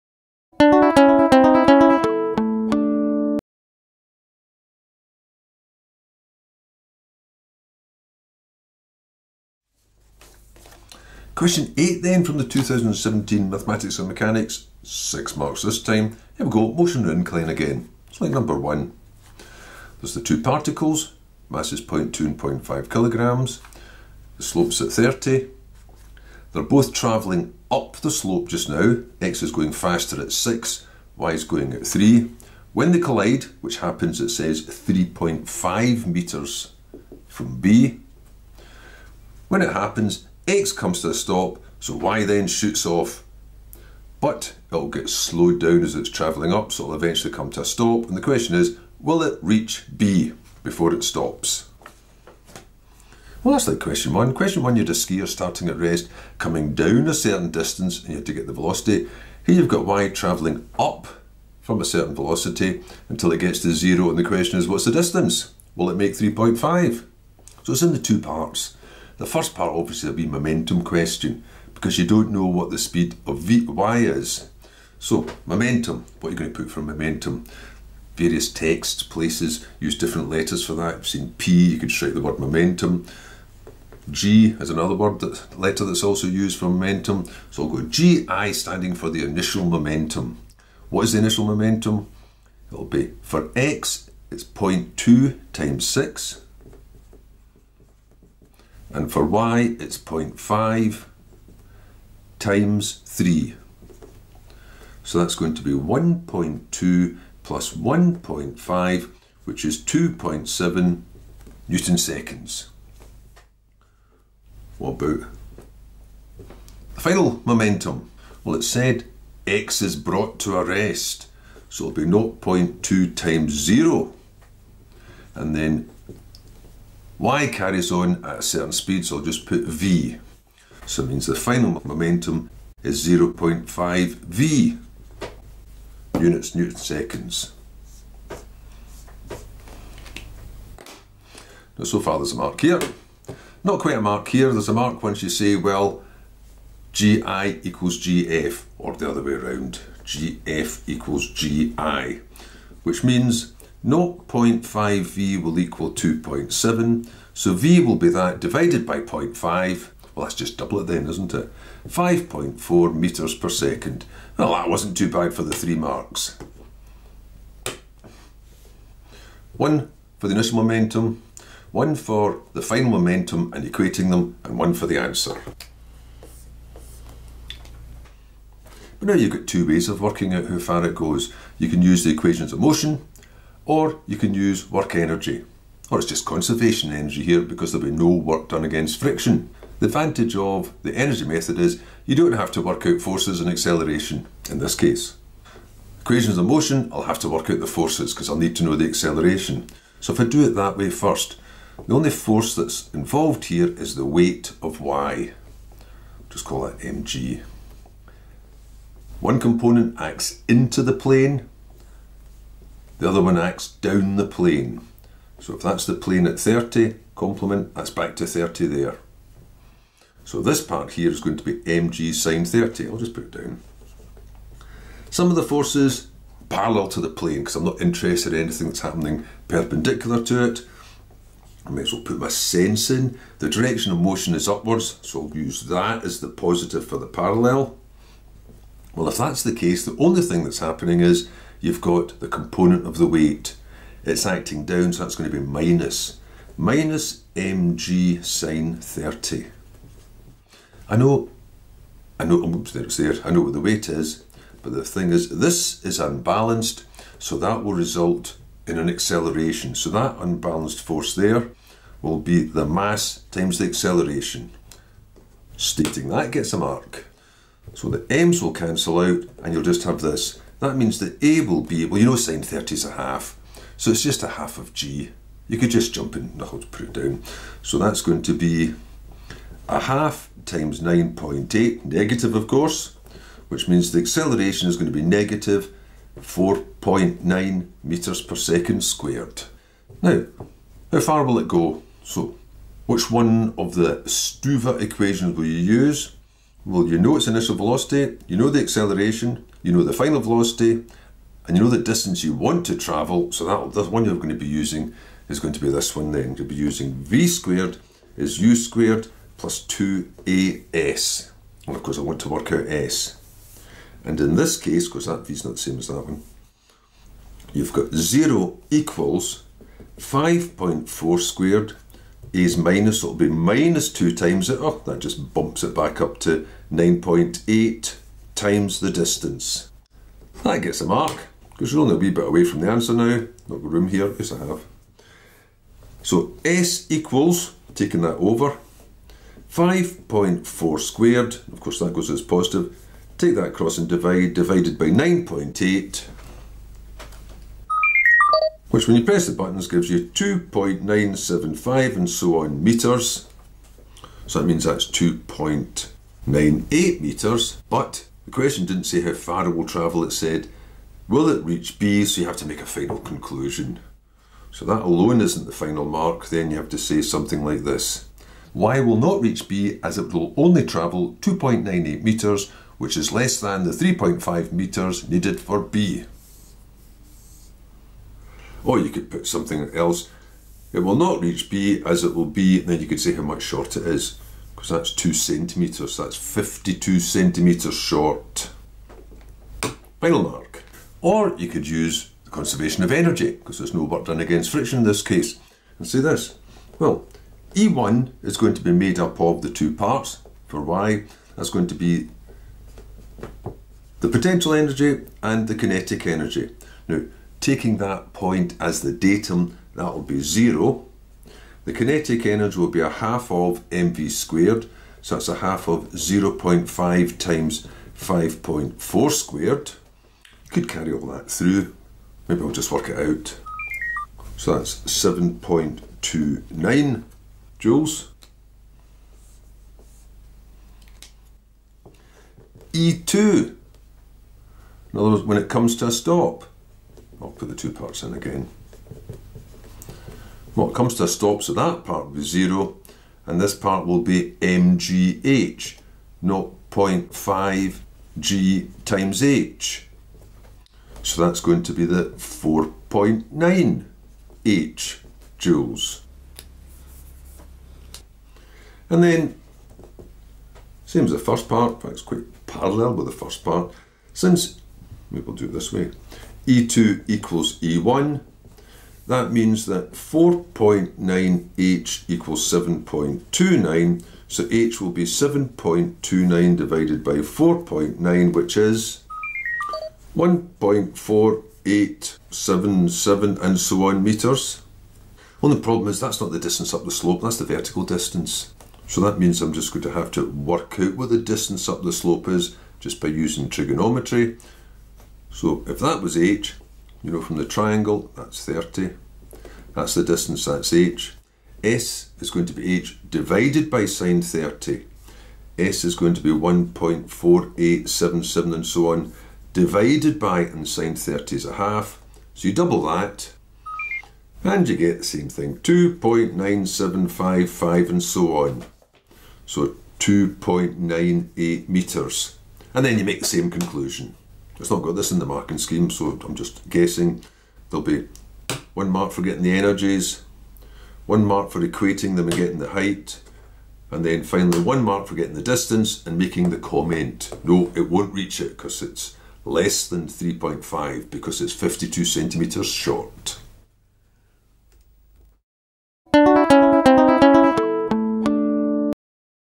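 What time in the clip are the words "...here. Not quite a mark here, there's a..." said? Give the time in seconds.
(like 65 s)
142 s.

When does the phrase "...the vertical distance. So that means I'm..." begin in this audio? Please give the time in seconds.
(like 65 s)
487 s.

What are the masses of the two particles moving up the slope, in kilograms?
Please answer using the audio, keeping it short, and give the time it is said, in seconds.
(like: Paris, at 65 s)
0.2 and 0.5, at 21 s.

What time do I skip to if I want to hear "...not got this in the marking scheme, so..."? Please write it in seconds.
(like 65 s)
524 s.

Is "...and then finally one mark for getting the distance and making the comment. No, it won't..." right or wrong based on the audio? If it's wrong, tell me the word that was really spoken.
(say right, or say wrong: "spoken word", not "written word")
right.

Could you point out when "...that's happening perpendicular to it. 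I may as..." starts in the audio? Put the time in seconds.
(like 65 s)
228 s.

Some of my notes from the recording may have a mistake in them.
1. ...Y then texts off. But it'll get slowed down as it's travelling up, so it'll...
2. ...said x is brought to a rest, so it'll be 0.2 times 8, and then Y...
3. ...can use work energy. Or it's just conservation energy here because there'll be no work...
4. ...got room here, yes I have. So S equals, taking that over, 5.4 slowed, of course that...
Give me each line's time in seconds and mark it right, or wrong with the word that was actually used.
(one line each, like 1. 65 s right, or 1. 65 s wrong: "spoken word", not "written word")
1. 41 s wrong: "shoots", not "texts"
2. 118 s wrong: "0", not "8"
3. 184 s right
4. 333 s wrong: "squared", not "slowed".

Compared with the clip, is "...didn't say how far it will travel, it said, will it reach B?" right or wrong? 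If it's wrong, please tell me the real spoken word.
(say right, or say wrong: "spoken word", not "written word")
right.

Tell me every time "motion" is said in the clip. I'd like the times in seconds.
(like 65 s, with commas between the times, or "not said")
16 s, 182 s, 196 s, 233 s.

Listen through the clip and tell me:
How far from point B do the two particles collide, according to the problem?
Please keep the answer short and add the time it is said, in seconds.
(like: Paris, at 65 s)
3.5 metres, at 34 s.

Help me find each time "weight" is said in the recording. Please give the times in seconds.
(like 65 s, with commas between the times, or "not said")
204 s, 243 s, 253 s.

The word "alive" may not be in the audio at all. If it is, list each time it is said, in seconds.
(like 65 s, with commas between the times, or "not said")
not said.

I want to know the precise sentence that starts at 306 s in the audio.
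You'll be using v squared is u squared plus 2as.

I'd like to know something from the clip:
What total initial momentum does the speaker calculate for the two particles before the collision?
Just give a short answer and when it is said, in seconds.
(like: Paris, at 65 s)
2.7 Newton seconds, at 109 s.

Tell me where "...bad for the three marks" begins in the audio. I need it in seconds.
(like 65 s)
165 s.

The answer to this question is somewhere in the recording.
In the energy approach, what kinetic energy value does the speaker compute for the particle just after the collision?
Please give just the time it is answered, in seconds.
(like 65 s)
424 s.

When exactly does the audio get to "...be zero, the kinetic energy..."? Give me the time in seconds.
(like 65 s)
410 s.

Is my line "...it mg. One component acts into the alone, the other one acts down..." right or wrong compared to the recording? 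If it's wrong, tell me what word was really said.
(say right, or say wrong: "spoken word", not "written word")
wrong: "plane", not "alone".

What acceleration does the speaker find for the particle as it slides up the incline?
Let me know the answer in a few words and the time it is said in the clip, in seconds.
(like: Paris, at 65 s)
-4.9 metres per second squared, at 285 s.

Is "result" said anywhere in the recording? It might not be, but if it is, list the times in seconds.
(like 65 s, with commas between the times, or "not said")
257 s.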